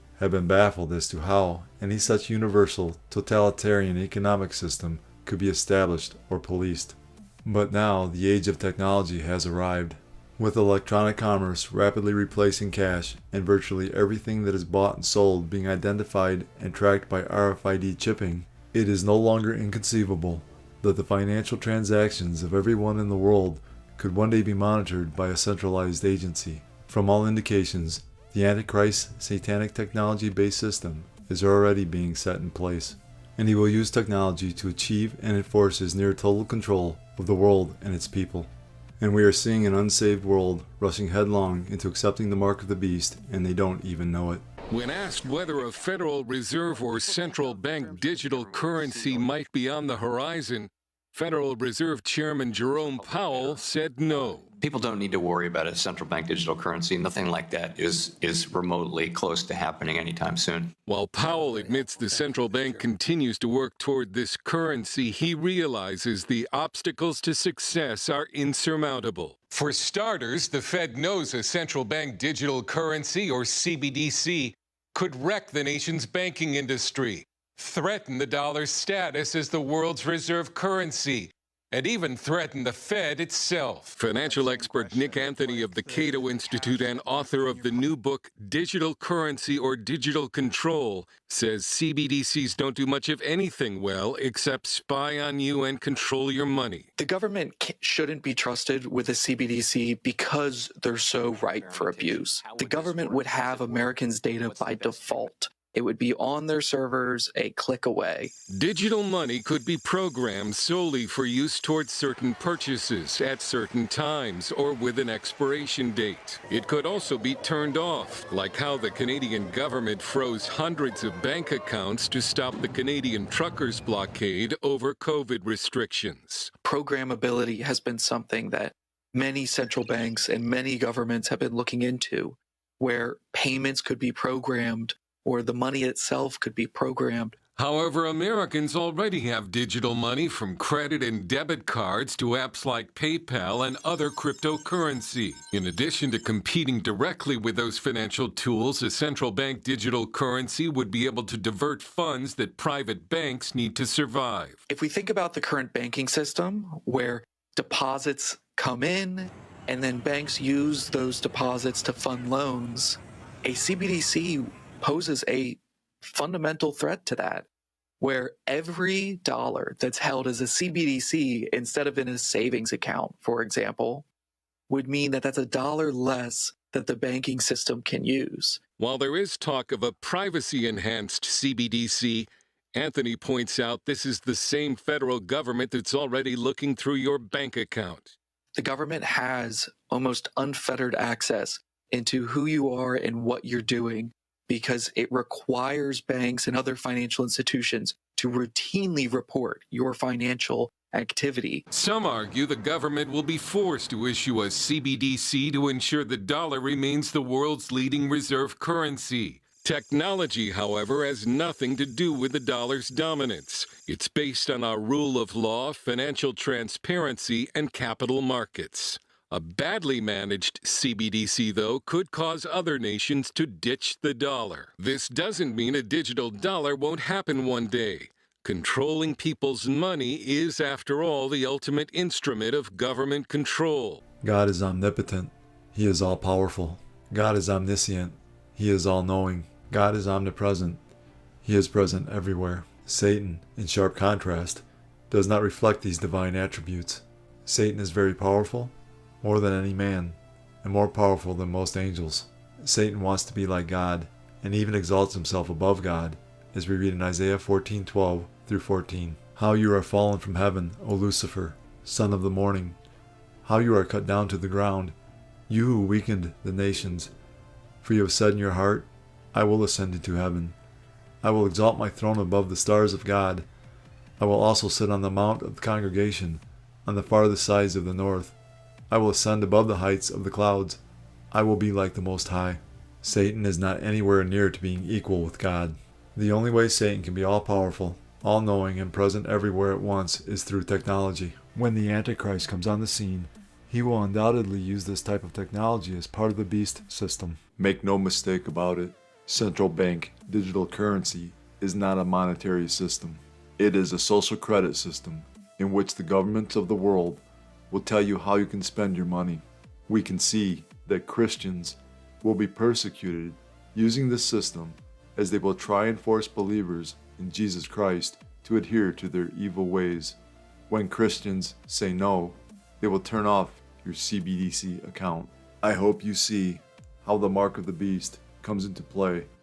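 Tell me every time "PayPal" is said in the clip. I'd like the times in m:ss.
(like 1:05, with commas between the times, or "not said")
2:22.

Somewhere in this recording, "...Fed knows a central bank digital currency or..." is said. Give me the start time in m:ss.
1:10.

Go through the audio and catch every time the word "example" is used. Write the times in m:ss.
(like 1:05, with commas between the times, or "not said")
2:53.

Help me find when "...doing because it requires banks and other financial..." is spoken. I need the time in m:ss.
3:13.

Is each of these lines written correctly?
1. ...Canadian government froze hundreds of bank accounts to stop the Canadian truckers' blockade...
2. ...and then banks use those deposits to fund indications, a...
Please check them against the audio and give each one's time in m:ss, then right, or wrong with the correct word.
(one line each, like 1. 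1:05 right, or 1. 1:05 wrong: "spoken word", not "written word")
1. 1:58 right
2. 2:39 wrong: "loans", not "indications".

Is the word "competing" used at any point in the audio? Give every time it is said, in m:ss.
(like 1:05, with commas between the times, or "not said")
2:26.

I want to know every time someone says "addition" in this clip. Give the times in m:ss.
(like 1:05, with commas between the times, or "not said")
2:25.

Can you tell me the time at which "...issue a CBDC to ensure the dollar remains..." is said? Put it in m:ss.
3:24.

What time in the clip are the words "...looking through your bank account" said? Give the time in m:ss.
3:06.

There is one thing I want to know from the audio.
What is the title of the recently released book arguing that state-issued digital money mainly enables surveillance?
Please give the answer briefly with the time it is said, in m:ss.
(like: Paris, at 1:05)
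Digital Currency or Digital Control, at 1:28.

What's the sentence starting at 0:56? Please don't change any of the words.
Nothing like that is is remotely close to happening anytime soon.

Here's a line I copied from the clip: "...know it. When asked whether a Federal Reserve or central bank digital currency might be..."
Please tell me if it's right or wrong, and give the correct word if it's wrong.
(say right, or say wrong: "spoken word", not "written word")
right.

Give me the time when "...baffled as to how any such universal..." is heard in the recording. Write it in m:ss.
0:00.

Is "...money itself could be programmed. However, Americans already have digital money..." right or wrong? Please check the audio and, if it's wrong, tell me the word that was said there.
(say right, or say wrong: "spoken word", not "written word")
right.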